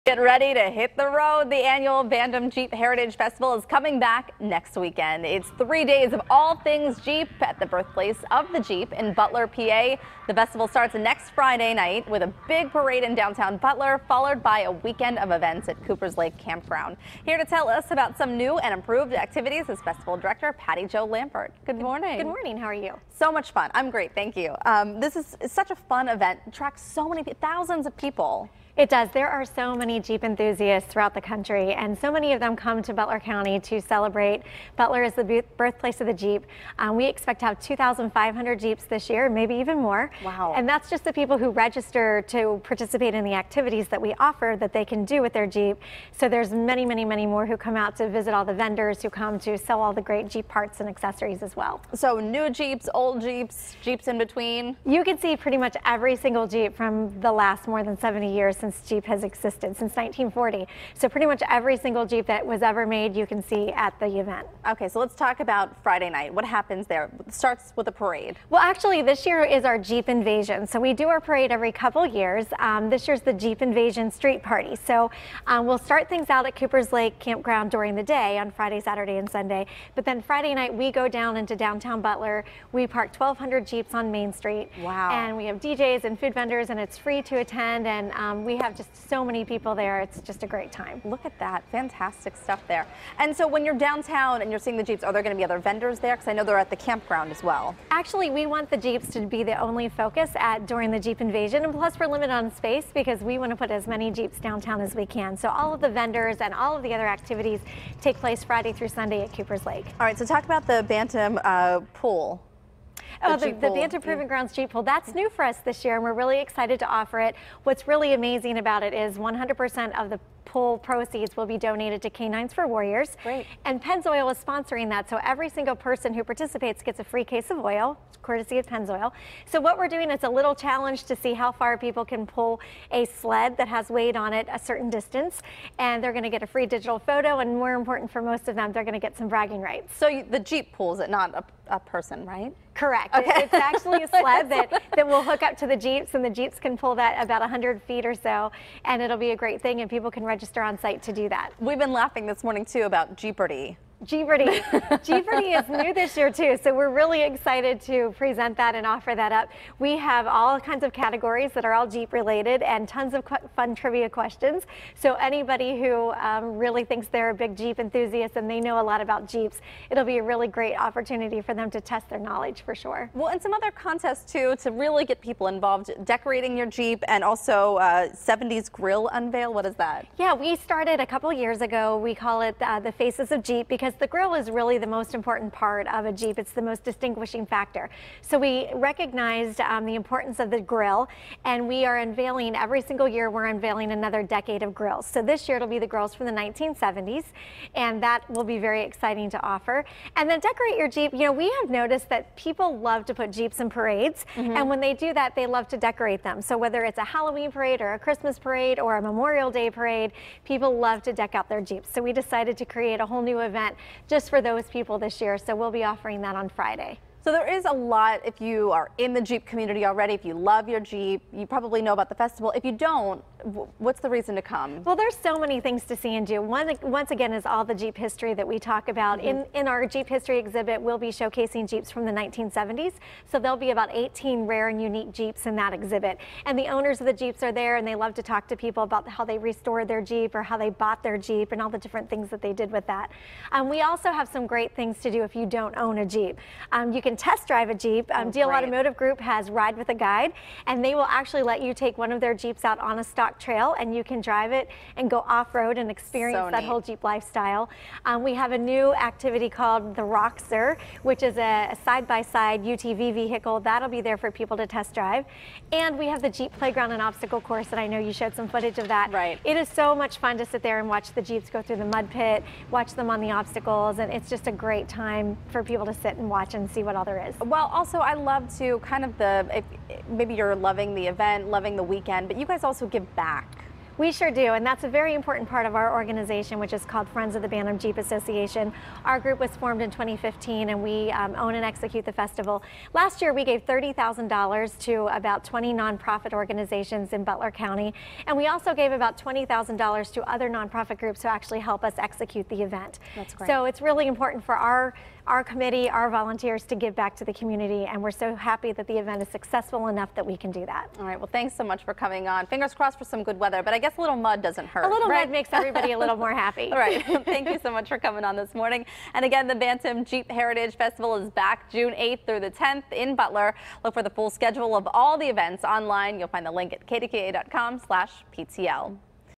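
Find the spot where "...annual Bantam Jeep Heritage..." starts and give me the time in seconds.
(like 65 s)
1 s.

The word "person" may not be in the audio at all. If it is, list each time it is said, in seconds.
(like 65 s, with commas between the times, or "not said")
125 s, 141 s.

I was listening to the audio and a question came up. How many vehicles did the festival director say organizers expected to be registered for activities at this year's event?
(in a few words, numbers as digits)
2,500.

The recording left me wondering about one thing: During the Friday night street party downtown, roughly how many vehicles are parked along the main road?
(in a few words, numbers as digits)
1,200.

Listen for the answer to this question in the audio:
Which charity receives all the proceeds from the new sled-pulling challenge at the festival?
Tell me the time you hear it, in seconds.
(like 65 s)
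122 s.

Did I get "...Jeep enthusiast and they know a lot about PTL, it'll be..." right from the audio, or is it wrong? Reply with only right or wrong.
wrong.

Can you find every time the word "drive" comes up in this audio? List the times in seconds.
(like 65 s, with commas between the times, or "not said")
247 s, 254 s, 264 s.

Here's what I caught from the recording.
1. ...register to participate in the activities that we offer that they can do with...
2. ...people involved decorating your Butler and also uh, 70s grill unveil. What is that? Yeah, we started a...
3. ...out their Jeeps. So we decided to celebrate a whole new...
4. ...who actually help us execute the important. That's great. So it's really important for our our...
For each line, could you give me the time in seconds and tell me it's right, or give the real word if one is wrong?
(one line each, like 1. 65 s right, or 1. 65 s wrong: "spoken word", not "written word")
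1. 41 s right
2. 175 s wrong: "Jeep", not "Butler"
3. 211 s wrong: "create", not "celebrate"
4. 301 s wrong: "event", not "important".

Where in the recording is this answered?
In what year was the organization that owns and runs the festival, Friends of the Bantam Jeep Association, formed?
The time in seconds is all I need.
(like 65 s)
289 s.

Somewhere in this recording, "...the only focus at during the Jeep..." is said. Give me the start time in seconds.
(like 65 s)
99 s.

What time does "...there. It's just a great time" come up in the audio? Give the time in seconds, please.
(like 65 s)
89 s.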